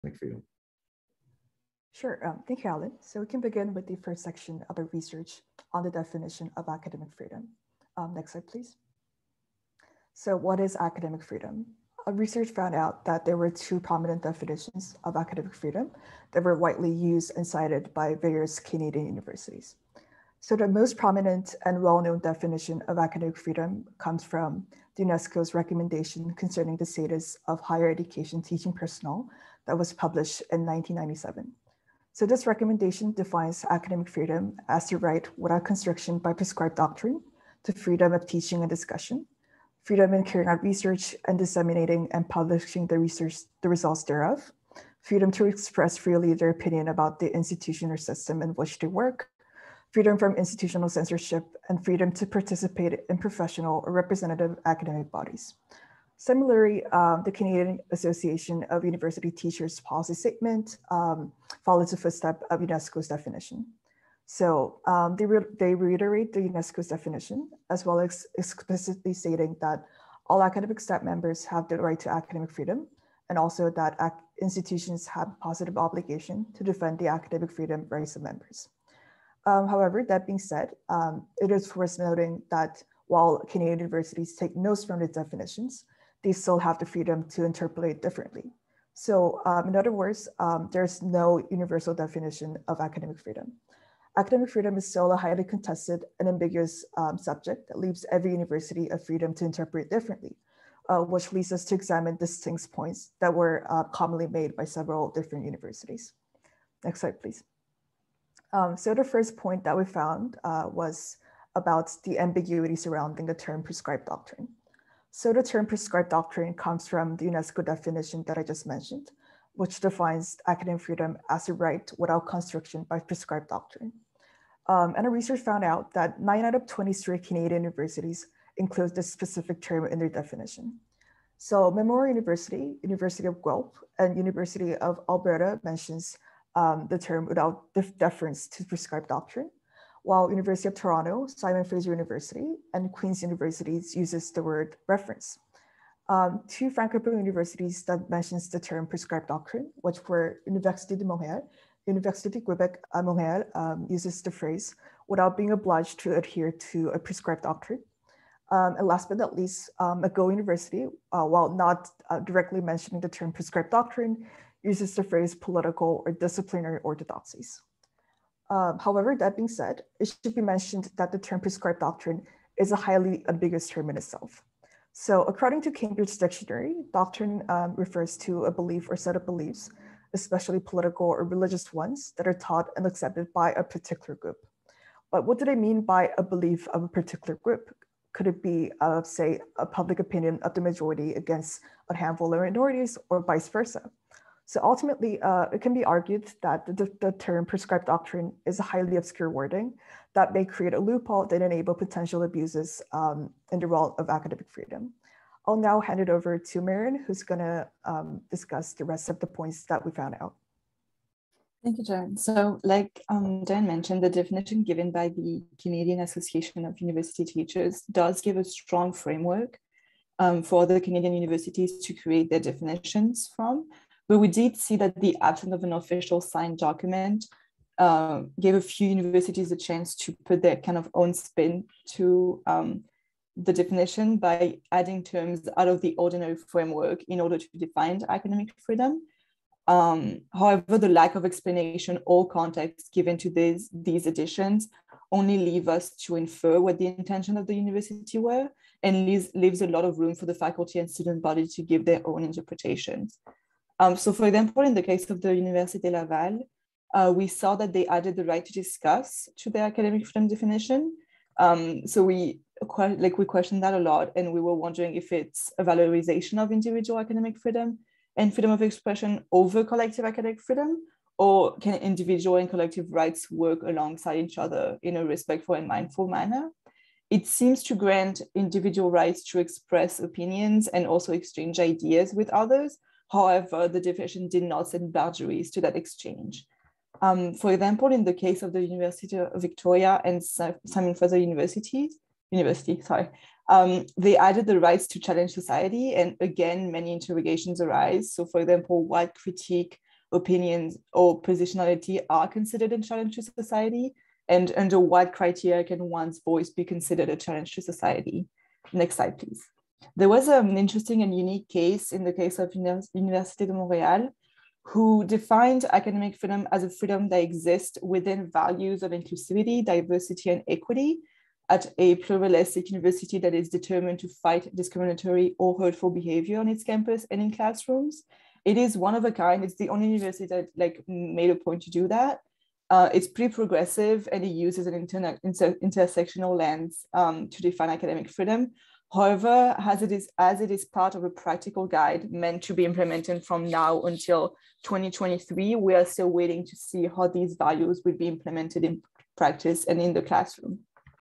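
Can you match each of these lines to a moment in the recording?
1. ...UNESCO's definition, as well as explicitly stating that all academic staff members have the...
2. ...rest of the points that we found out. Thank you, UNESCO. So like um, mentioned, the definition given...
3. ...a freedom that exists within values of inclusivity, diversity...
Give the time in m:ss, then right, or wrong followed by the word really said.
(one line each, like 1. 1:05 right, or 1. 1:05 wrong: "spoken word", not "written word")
1. 1:06 right
2. 3:28 wrong: "John", not "UNESCO"
3. 5:16 right.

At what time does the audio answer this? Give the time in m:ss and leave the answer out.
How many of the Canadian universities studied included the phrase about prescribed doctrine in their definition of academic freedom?
2:06.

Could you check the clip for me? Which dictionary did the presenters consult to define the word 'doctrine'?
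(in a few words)
Cambridge Dictionary.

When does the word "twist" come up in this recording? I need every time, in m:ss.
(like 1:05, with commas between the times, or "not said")
not said.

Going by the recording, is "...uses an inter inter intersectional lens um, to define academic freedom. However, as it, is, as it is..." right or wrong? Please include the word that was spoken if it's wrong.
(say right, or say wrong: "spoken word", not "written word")
right.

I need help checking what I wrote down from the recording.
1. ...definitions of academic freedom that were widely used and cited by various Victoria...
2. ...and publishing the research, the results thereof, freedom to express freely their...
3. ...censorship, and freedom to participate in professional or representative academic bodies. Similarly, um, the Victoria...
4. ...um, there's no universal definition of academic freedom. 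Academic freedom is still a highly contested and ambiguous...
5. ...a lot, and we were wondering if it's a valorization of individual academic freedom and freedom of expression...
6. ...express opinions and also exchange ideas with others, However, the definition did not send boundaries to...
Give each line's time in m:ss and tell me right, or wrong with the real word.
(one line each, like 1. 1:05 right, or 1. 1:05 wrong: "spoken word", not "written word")
1. 0:14 wrong: "Canadian", not "Victoria"
2. 0:42 right
3. 0:50 wrong: "Canadian", not "Victoria"
4. 1:30 right
5. 4:23 right
6. 4:39 right.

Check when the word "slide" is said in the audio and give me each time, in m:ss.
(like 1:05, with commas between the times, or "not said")
0:08, 1:47, 5:08.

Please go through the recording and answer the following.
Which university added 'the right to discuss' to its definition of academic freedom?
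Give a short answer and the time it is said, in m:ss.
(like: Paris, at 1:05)
Université Laval, at 4:15.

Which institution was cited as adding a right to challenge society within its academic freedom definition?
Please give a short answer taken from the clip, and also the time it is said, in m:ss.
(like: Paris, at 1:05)
University of Victoria, at 4:48.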